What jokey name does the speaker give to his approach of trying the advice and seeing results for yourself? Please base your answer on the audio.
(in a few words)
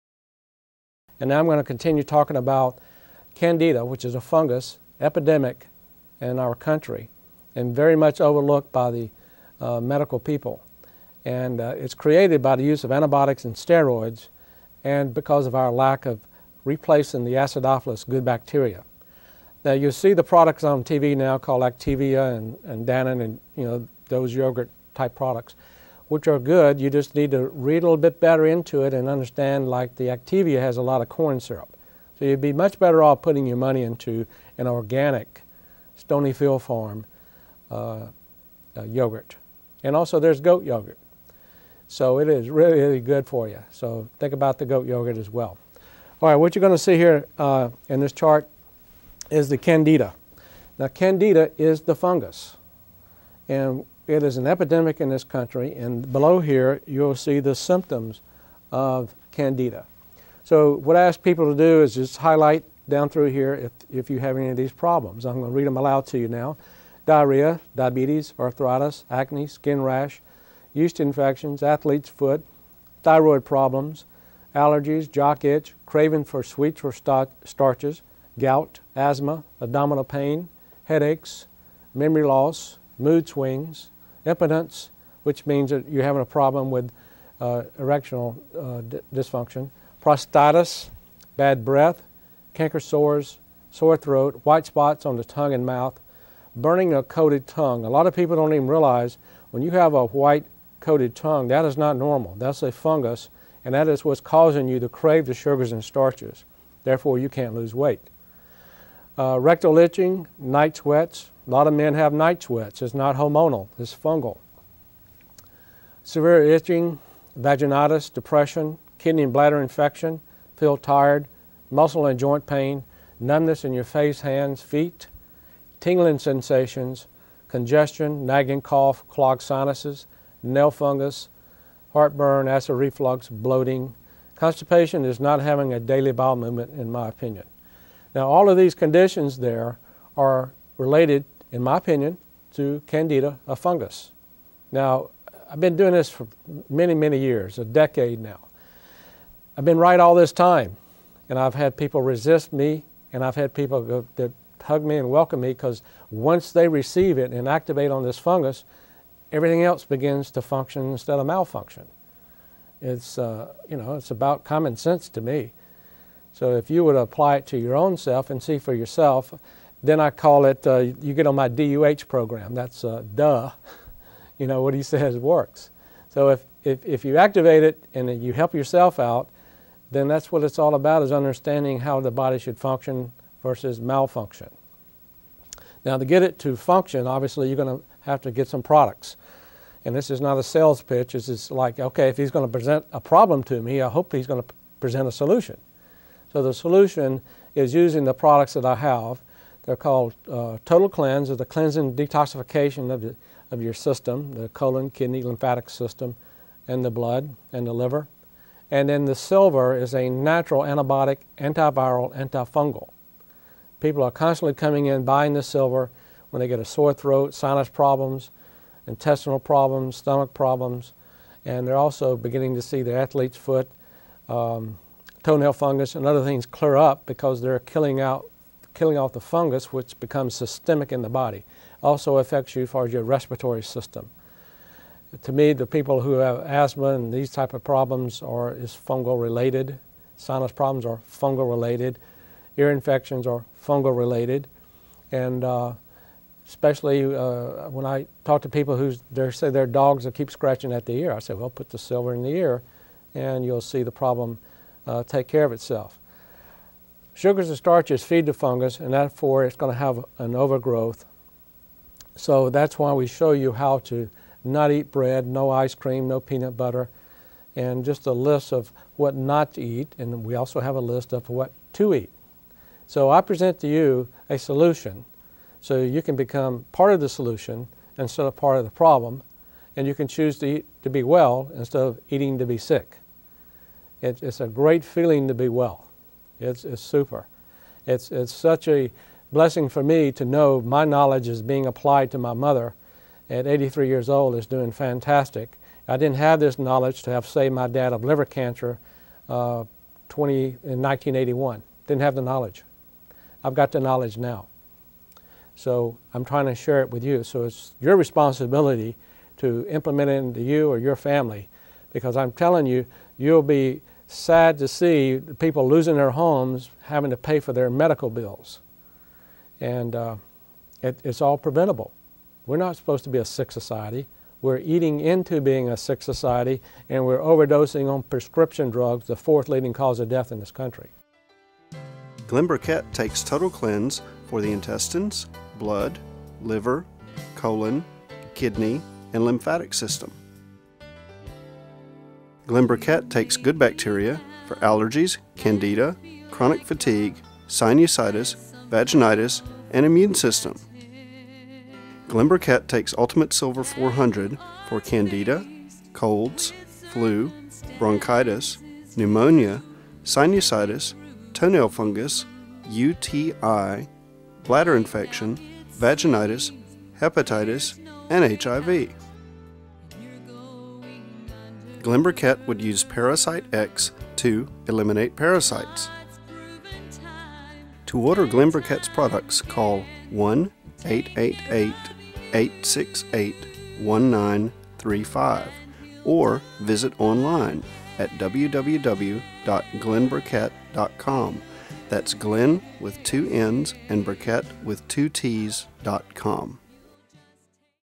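DUH program.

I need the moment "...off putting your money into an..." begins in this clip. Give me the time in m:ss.
0:33.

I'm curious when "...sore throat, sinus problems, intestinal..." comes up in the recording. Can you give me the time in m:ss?
3:36.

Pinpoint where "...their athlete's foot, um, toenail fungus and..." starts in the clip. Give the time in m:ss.
3:42.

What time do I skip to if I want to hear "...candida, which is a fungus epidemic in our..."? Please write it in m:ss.
0:03.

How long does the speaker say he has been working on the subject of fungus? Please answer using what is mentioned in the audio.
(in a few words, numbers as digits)
A decade.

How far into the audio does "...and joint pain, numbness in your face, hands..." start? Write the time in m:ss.
2:02.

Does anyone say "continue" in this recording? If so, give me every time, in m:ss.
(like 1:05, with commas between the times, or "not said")
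0:01.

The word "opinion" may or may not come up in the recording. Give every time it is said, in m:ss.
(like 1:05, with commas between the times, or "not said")
2:17, 2:21.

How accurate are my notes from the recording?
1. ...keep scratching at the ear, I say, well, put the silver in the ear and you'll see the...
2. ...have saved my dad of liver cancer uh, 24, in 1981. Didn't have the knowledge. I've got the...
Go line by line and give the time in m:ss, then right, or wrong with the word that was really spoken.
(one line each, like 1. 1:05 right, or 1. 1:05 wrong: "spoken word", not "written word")
1. 4:10 right
2. 4:57 wrong: "20", not "24".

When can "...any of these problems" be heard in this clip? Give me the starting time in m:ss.
1:04.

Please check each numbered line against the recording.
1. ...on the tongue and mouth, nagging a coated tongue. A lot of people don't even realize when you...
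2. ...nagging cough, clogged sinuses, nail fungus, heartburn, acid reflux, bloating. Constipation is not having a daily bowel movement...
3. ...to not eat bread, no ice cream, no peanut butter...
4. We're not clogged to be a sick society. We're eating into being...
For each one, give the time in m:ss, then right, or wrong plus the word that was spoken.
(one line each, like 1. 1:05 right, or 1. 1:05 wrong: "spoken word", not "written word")
1. 1:35 wrong: "burning", not "nagging"
2. 2:08 right
3. 4:23 right
4. 5:22 wrong: "supposed", not "clogged".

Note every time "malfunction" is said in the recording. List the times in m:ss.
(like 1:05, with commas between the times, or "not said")
2:41, 3:03.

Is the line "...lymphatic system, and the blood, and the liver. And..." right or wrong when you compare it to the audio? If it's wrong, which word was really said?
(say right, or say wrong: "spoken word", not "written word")
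right.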